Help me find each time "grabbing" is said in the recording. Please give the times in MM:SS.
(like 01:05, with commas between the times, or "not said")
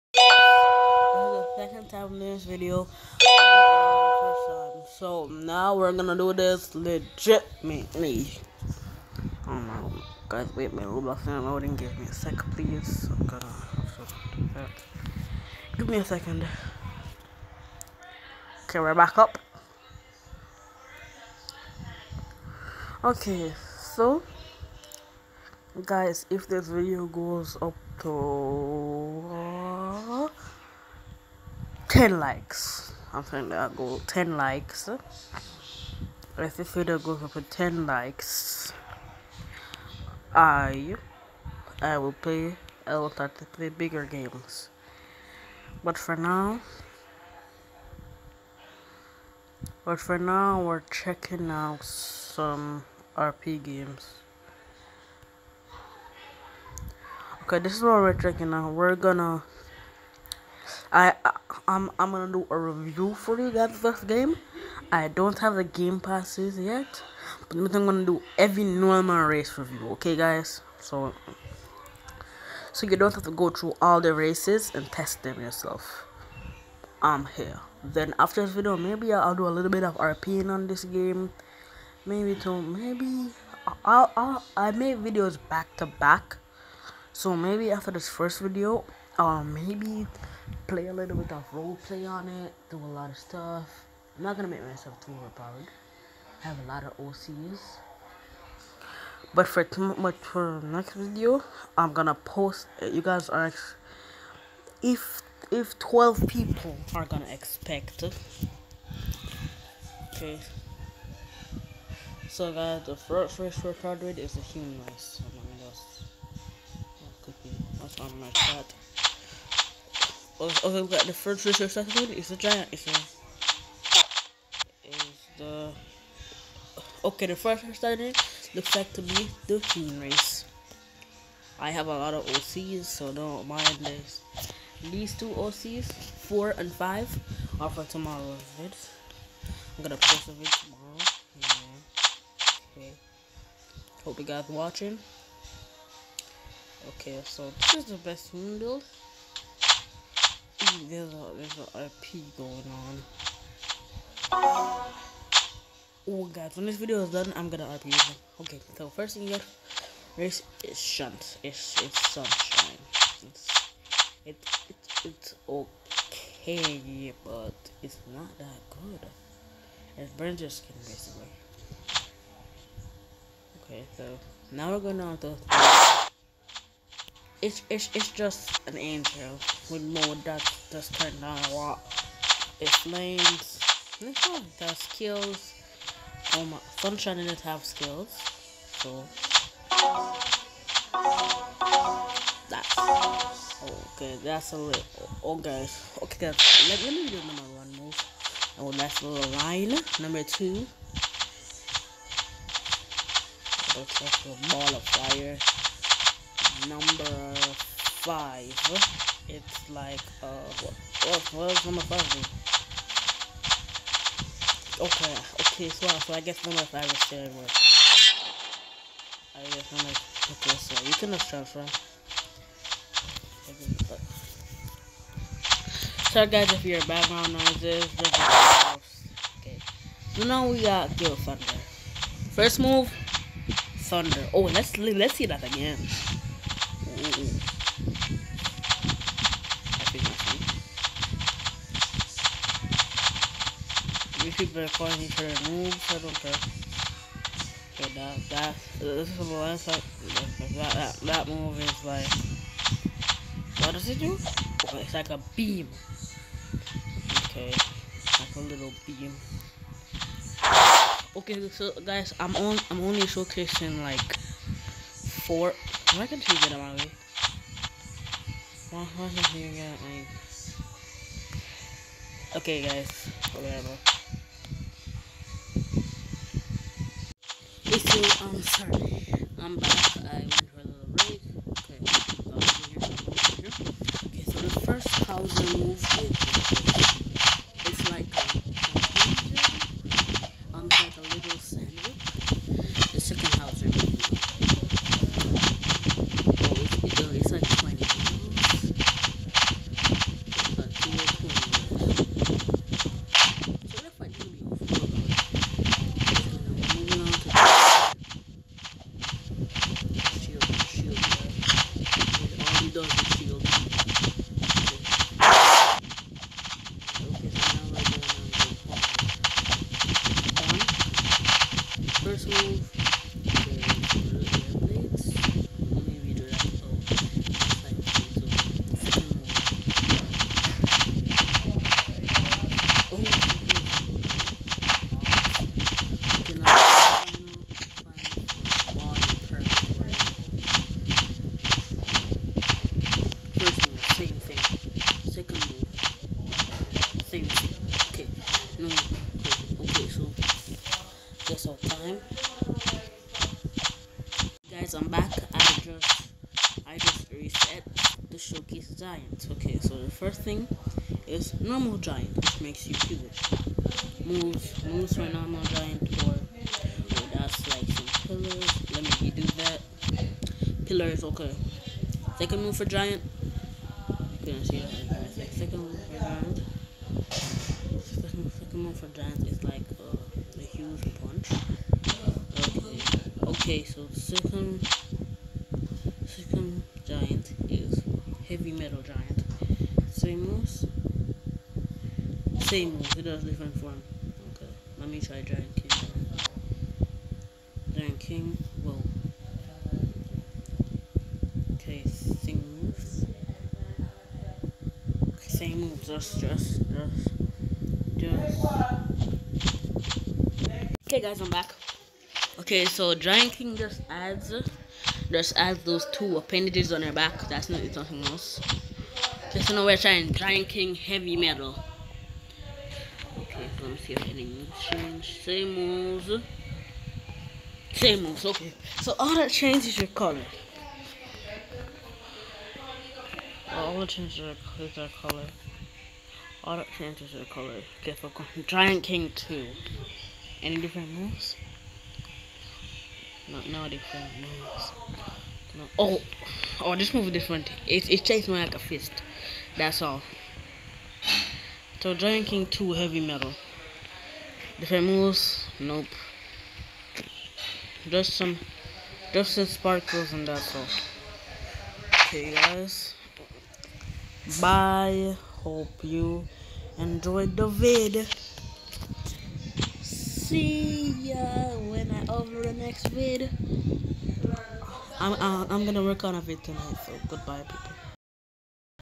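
not said.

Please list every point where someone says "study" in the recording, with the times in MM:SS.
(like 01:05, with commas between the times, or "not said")
02:01, 02:07.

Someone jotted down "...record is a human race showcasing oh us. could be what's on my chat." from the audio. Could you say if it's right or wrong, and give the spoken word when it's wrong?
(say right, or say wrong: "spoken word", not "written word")
wrong: "among", not "showcasing".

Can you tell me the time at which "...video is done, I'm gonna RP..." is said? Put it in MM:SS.
02:36.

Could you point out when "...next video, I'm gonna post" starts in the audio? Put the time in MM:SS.
01:40.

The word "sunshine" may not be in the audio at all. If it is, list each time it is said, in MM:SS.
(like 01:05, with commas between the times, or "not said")
02:42, 03:06.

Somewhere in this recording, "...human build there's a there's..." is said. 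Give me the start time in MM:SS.
02:28.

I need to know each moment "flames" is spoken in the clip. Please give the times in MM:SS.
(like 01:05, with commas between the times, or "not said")
03:02.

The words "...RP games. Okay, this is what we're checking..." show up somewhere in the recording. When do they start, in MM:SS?
00:53.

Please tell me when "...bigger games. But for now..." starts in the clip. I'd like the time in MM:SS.
00:43.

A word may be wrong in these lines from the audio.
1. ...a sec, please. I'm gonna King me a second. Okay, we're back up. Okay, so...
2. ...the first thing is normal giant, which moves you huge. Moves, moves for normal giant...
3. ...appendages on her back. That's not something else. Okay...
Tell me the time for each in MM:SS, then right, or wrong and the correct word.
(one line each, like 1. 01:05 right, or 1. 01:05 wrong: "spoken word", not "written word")
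1. 00:12 wrong: "Give", not "King"
2. 05:59 wrong: "makes", not "moves"
3. 06:56 right.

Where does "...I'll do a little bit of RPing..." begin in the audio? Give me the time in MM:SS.
01:19.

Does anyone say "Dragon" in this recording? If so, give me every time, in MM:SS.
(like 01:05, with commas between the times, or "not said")
07:31.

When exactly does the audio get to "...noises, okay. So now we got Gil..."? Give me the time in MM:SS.
03:47.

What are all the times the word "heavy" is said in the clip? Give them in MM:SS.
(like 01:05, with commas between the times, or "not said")
07:00, 07:32.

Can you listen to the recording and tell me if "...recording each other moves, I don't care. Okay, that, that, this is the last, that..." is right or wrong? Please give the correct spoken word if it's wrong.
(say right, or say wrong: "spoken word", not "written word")
right.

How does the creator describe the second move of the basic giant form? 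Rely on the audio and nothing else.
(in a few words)
A huge punch.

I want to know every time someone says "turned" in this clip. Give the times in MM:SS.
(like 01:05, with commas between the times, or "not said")
03:00.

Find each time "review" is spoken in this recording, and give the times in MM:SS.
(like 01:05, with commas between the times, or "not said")
01:02, 01:09.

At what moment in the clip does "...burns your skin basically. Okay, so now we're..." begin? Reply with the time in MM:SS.
02:50.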